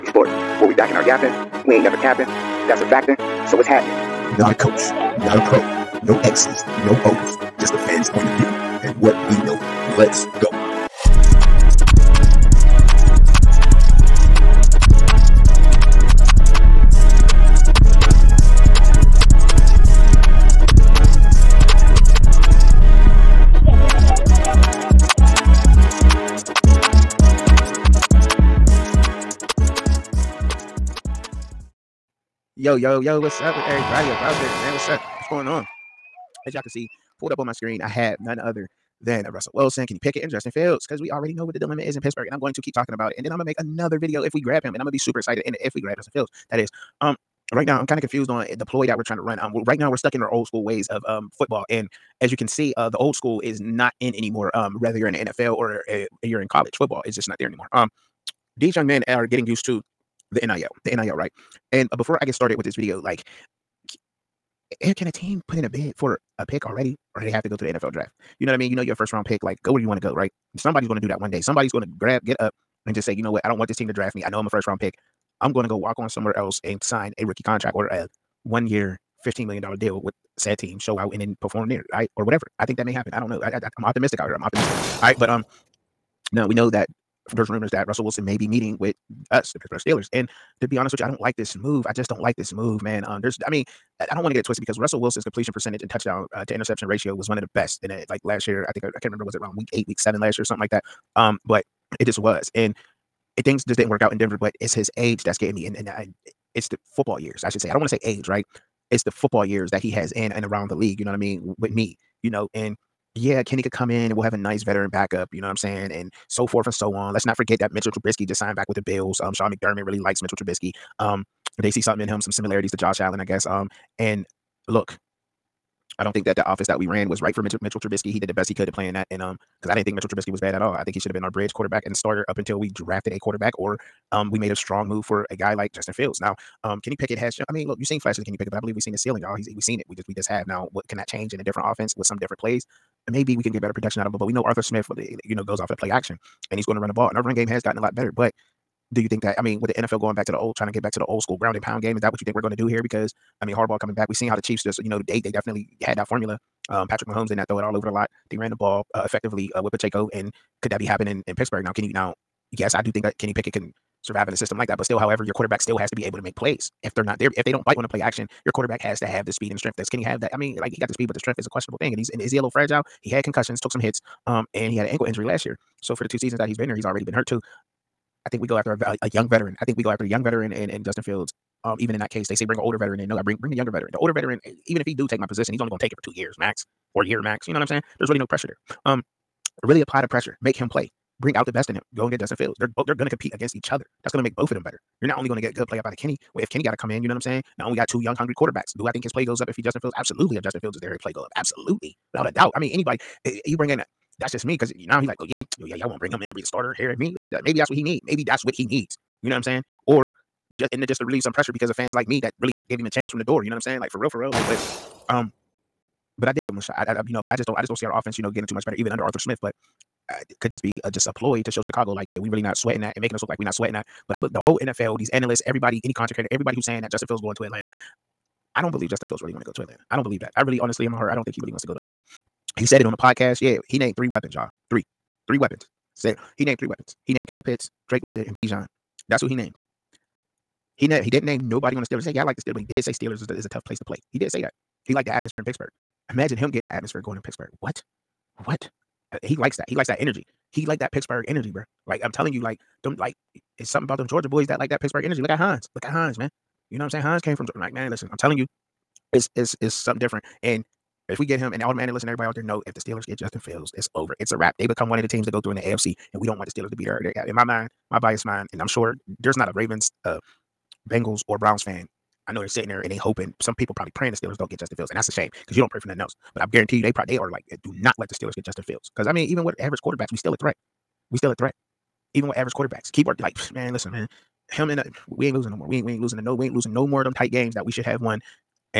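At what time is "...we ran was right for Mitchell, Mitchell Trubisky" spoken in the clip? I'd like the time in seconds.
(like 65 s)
126 s.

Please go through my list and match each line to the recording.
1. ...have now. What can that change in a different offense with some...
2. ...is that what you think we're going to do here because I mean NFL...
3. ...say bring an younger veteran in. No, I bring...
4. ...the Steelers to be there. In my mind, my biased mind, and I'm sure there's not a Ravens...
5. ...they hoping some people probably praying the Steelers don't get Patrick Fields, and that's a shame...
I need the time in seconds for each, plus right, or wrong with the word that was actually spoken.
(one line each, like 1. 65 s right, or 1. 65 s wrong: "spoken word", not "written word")
1. 140 s right
2. 151 s wrong: "Harbaugh", not "NFL"
3. 182 s wrong: "older", not "younger"
4. 266 s right
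5. 272 s wrong: "Justin", not "Patrick".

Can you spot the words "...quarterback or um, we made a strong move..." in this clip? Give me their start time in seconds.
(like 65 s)
133 s.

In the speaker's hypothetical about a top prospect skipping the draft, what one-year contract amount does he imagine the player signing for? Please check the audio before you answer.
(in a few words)
$15 million.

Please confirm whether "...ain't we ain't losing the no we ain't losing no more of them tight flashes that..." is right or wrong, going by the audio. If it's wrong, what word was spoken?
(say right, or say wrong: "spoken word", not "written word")
wrong: "games", not "flashes".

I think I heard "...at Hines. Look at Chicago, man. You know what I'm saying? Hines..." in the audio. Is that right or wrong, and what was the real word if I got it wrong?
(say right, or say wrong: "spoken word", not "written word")
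wrong: "Hines", not "Chicago".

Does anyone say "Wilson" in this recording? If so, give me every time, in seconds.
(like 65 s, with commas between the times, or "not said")
39 s, 88 s, 94 s.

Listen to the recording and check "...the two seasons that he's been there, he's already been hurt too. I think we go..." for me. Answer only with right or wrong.
right.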